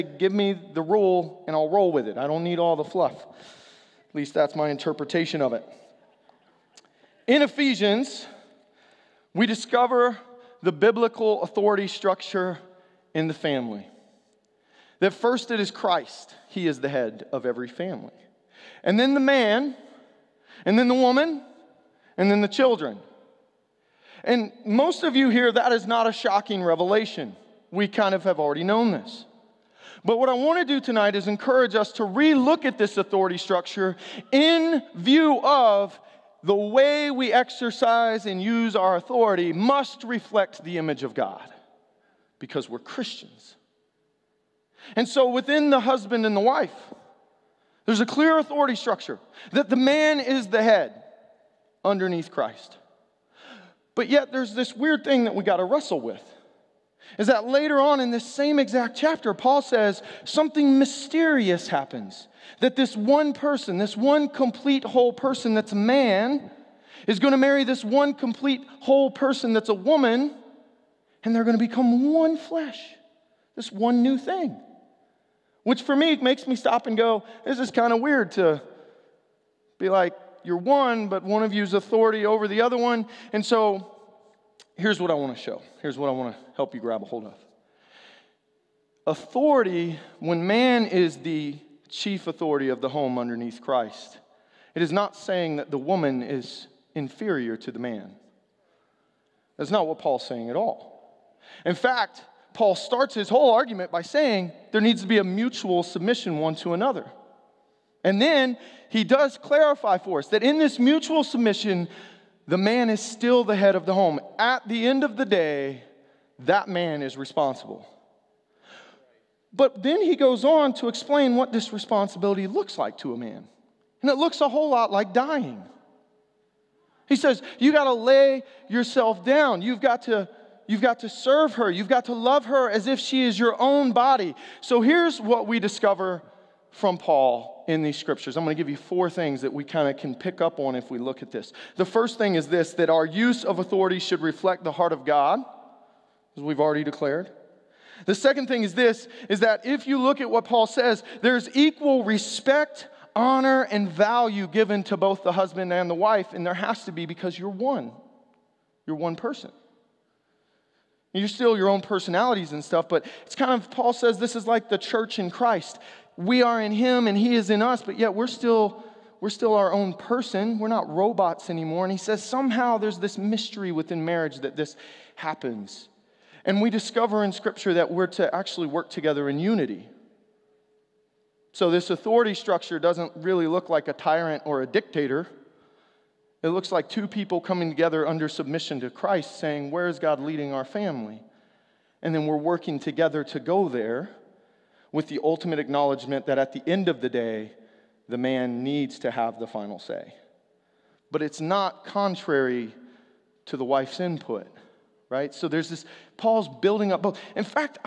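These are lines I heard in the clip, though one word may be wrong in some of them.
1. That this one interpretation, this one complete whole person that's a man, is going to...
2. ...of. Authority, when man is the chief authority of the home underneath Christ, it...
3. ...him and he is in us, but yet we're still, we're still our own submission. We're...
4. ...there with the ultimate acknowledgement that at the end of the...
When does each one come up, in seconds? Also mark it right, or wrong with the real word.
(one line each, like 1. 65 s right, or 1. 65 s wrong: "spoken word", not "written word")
1. 62 s wrong: "person", not "interpretation"
2. 87 s right
3. 166 s wrong: "person", not "submission"
4. 193 s right.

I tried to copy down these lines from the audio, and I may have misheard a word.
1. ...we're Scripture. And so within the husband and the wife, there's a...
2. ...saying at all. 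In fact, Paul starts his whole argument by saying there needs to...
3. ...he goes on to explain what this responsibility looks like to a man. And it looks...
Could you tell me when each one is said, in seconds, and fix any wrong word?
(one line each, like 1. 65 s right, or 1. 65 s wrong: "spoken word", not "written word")
1. 42 s wrong: "Christians", not "Scripture"
2. 100 s right
3. 120 s right.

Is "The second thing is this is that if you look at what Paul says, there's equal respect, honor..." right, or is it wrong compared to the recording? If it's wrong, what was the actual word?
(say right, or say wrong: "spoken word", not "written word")
right.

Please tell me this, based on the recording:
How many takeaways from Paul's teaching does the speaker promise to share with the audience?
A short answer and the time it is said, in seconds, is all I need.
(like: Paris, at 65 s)
4, at 138 s.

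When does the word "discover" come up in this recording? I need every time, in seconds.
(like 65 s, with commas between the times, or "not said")
9 s, 135 s, 176 s.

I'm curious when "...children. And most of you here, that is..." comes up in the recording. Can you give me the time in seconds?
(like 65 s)
22 s.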